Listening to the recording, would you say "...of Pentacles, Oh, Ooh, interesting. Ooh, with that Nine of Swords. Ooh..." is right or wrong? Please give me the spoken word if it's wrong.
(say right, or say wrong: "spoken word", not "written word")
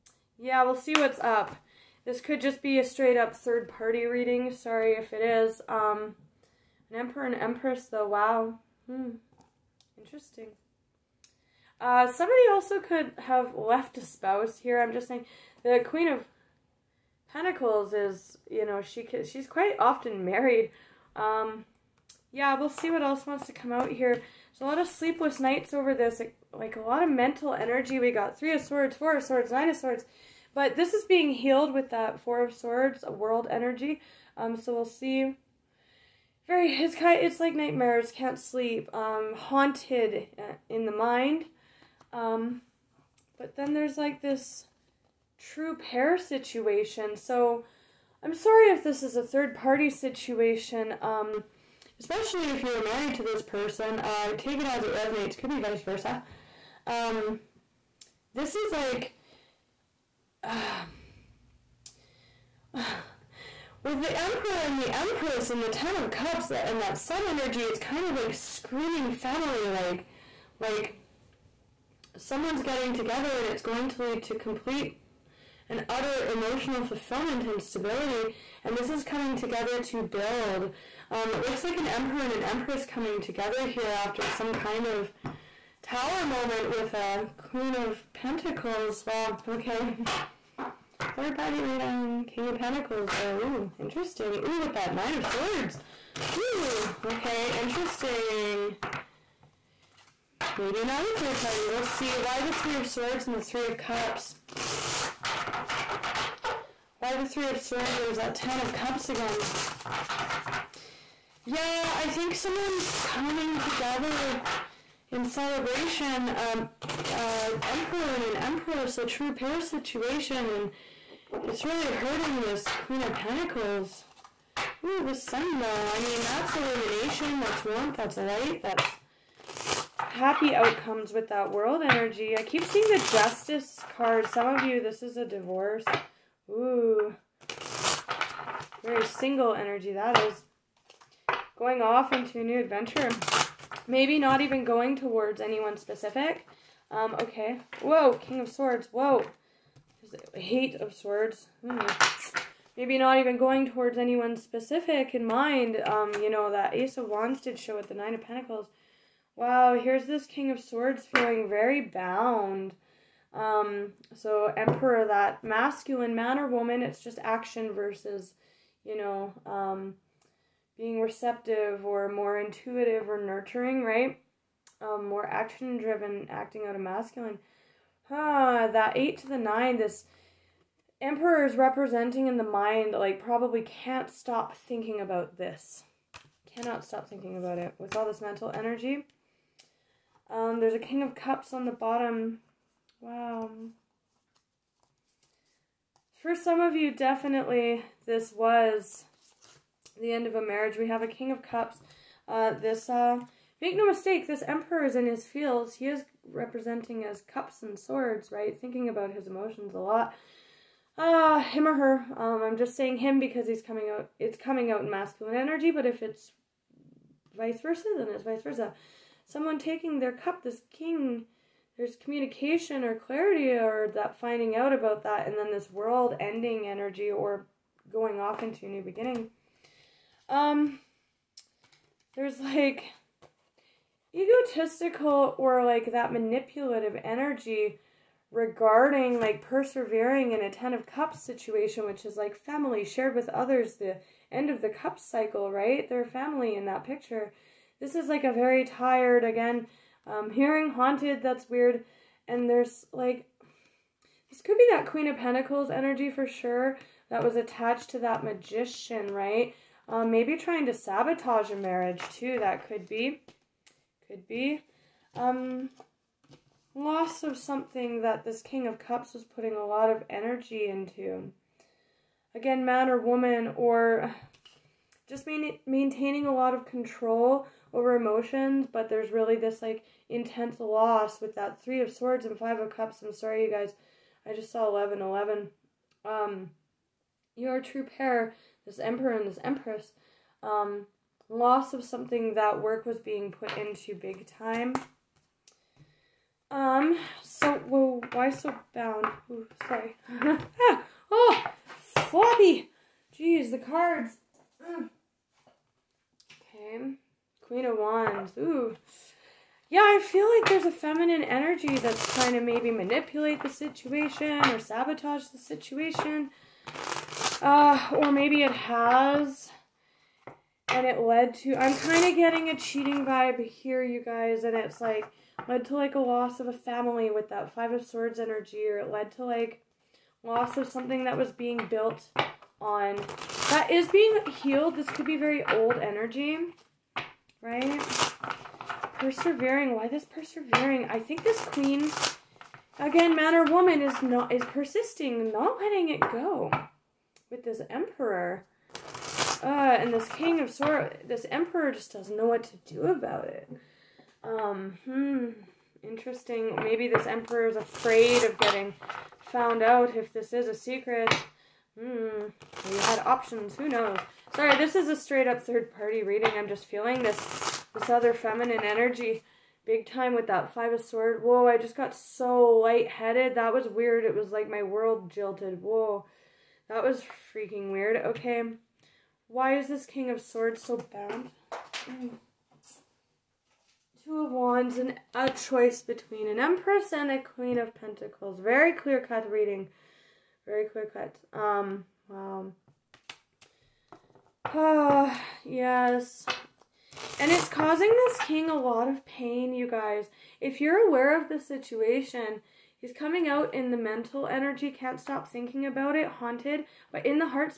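right.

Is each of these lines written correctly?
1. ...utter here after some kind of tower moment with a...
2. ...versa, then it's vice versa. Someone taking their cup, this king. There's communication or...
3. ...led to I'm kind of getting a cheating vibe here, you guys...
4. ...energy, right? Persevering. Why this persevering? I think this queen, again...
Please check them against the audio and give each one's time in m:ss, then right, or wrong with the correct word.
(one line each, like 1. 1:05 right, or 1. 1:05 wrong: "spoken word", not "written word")
1. 1:23 wrong: "together", not "utter"
2. 3:37 right
3. 5:20 right
4. 5:35 right.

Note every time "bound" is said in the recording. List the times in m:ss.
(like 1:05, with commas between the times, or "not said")
2:41, 4:58, 6:20.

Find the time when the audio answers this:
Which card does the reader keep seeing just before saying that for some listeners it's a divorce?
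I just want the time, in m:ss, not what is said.
2:13.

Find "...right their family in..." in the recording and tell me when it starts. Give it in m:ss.
4:05.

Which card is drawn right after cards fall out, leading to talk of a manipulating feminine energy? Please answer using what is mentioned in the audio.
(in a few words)
Queen of Wands.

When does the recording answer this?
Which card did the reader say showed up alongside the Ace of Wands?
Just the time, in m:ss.
2:37.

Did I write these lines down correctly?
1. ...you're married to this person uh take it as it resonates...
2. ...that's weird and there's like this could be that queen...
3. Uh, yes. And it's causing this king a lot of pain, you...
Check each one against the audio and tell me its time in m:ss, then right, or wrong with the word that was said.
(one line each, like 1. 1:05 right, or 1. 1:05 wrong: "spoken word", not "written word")
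1. 0:52 right
2. 4:11 right
3. 6:34 right.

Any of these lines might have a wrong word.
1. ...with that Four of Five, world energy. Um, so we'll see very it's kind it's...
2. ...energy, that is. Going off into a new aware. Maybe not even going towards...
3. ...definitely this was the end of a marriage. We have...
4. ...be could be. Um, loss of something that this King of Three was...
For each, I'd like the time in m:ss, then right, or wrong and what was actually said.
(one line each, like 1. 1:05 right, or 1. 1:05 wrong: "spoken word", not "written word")
1. 0:31 wrong: "Swords", not "Five"
2. 2:19 wrong: "adventure", not "aware"
3. 3:16 right
4. 4:22 wrong: "Cups", not "Three".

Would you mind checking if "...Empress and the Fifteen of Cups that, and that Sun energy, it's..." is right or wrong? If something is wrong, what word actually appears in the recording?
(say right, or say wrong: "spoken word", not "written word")
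wrong: "Ten", not "Fifteen".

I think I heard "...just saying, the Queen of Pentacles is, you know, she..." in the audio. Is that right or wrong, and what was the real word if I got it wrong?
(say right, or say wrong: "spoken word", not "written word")
right.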